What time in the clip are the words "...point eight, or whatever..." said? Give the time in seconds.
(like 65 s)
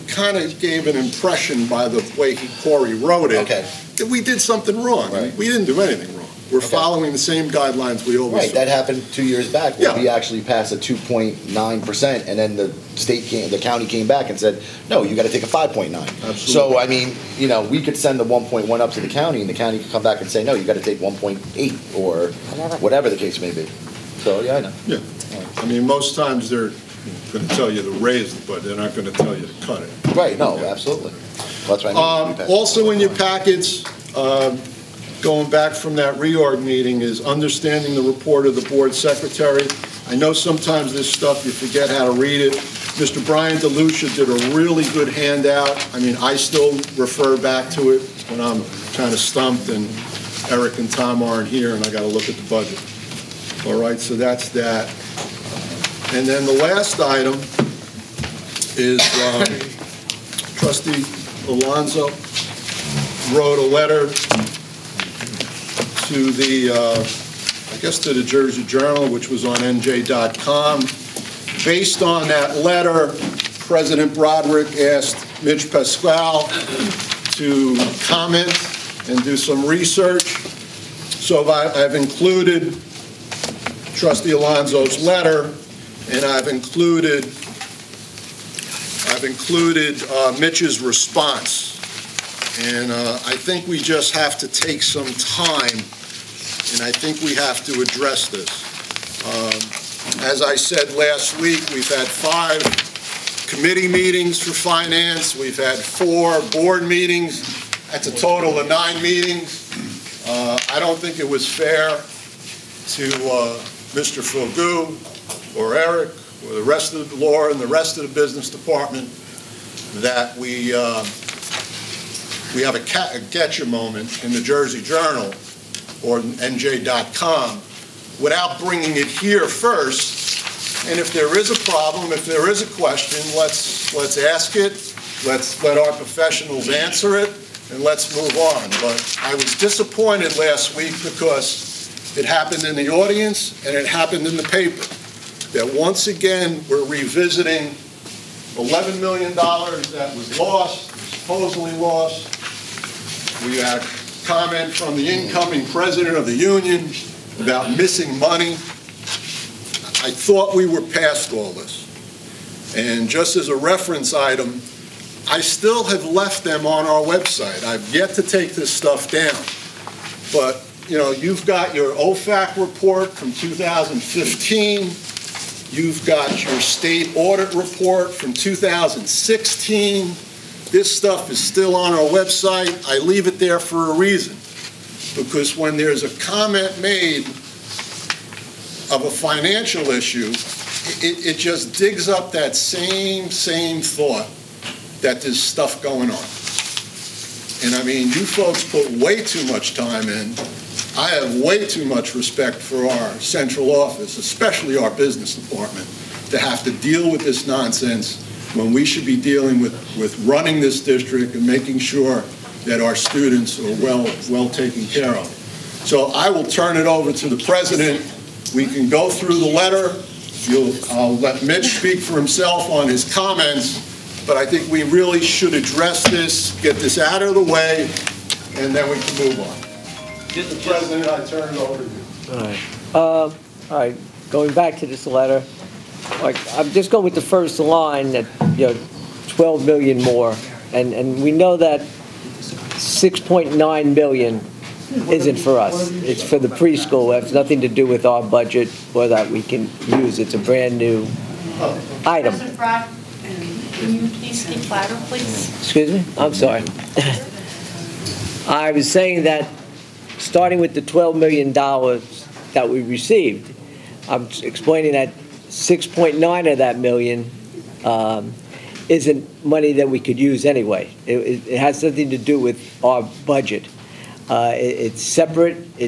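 21 s.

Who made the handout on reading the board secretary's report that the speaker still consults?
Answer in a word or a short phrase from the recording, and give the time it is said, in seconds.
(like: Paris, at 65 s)
Brian DeLucia, at 43 s.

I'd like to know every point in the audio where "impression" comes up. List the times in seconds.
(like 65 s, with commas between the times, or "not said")
0 s.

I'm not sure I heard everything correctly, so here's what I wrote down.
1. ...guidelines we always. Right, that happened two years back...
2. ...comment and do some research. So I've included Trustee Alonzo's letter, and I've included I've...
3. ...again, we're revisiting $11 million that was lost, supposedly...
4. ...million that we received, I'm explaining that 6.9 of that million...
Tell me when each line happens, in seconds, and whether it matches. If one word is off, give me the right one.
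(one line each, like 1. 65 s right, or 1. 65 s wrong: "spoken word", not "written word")
1. 7 s right
2. 78 s right
3. 146 s right
4. 261 s right.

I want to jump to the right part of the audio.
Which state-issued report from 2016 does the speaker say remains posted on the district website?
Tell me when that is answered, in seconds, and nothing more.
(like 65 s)
176 s.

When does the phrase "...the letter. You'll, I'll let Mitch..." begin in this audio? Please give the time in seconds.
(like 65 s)
219 s.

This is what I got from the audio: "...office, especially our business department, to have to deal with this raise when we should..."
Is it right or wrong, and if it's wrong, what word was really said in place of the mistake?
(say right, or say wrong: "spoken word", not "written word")
wrong: "nonsense", not "raise".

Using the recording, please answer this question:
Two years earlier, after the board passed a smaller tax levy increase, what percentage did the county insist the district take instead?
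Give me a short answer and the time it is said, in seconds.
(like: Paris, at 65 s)
5.9 percent, at 15 s.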